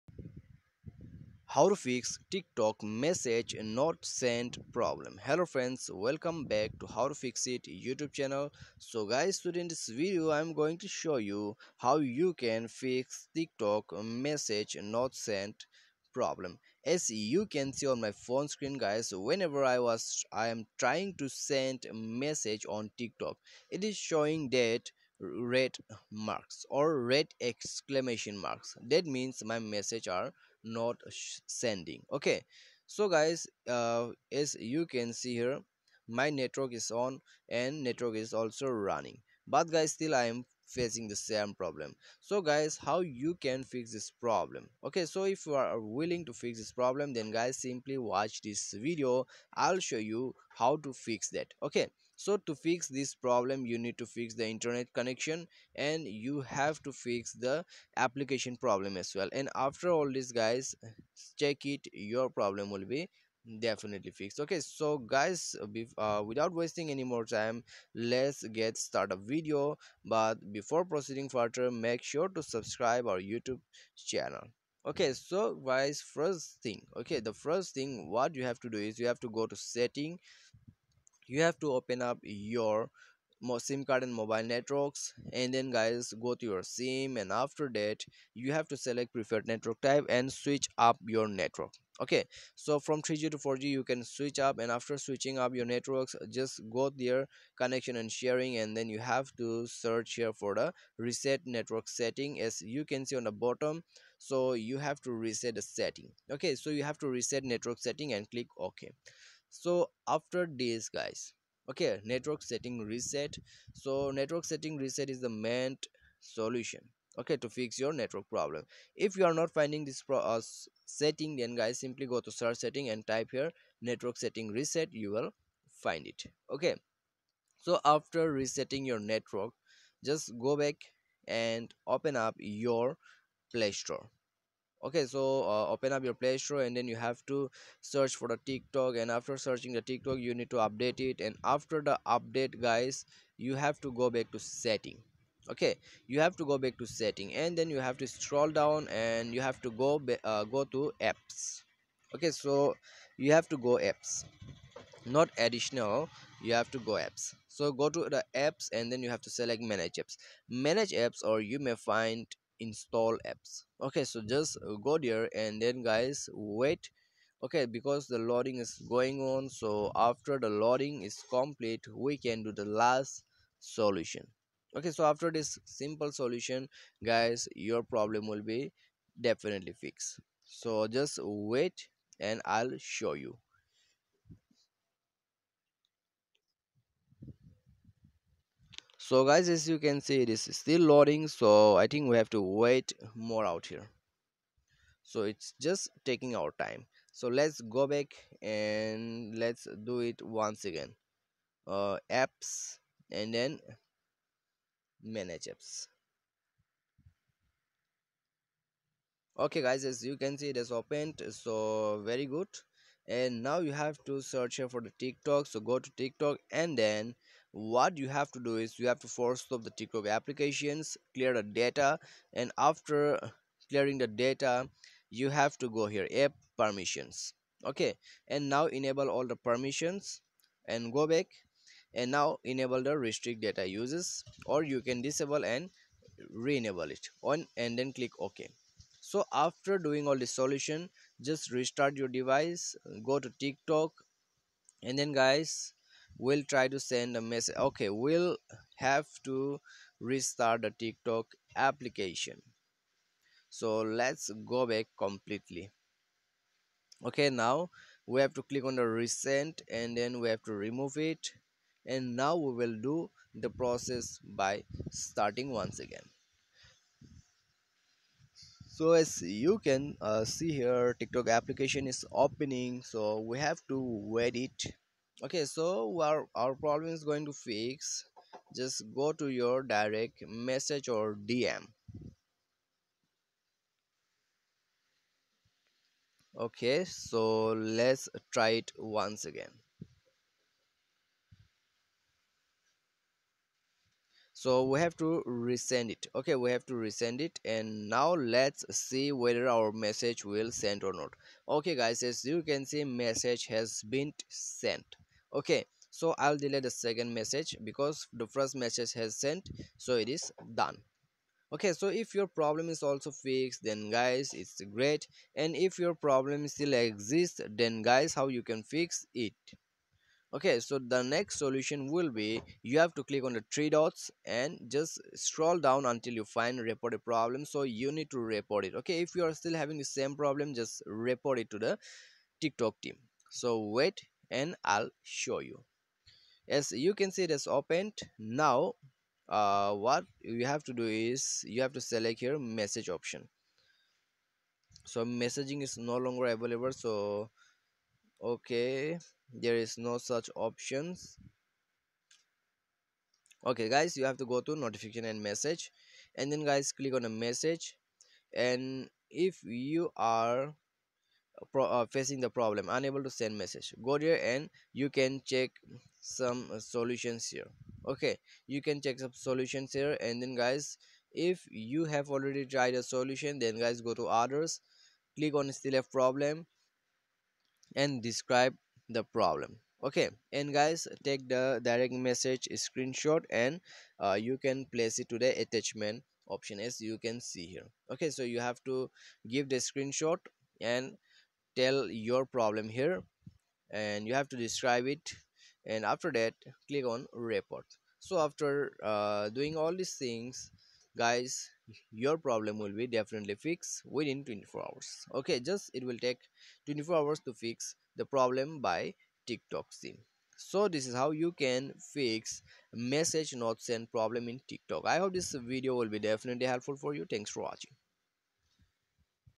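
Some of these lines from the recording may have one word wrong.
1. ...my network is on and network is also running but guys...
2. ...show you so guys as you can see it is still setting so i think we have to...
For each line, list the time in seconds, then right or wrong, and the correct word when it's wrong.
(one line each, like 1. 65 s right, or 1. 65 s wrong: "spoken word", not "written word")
1. 36 s right
2. 182 s wrong: "loading", not "setting".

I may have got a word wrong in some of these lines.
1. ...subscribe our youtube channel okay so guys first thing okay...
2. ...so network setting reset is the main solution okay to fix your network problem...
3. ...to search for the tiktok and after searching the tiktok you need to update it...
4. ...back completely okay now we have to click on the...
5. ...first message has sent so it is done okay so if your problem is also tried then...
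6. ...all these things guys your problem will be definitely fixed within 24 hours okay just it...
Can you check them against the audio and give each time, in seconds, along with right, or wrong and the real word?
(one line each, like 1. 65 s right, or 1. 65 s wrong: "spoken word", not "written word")
1. 72 s right
2. 113 s right
3. 137 s right
4. 254 s right
5. 308 s wrong: "fixed", not "tried"
6. 399 s right.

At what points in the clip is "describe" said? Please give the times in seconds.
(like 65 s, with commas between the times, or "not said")
378 s, 394 s.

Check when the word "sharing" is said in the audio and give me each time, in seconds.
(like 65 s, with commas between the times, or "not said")
98 s.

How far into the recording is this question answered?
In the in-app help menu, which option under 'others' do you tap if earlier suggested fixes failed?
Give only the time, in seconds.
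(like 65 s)
375 s.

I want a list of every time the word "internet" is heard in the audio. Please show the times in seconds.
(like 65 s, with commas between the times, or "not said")
54 s.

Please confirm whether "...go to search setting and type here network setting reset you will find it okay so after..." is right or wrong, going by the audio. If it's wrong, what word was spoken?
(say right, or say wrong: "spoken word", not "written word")
right.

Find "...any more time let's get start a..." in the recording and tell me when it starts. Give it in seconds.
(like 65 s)
66 s.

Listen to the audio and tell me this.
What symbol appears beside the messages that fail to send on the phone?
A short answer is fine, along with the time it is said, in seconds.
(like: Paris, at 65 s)
red exclamation marks, at 27 s.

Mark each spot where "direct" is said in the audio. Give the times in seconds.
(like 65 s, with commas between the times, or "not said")
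279 s, 381 s.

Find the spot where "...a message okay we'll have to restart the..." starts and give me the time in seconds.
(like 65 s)
247 s.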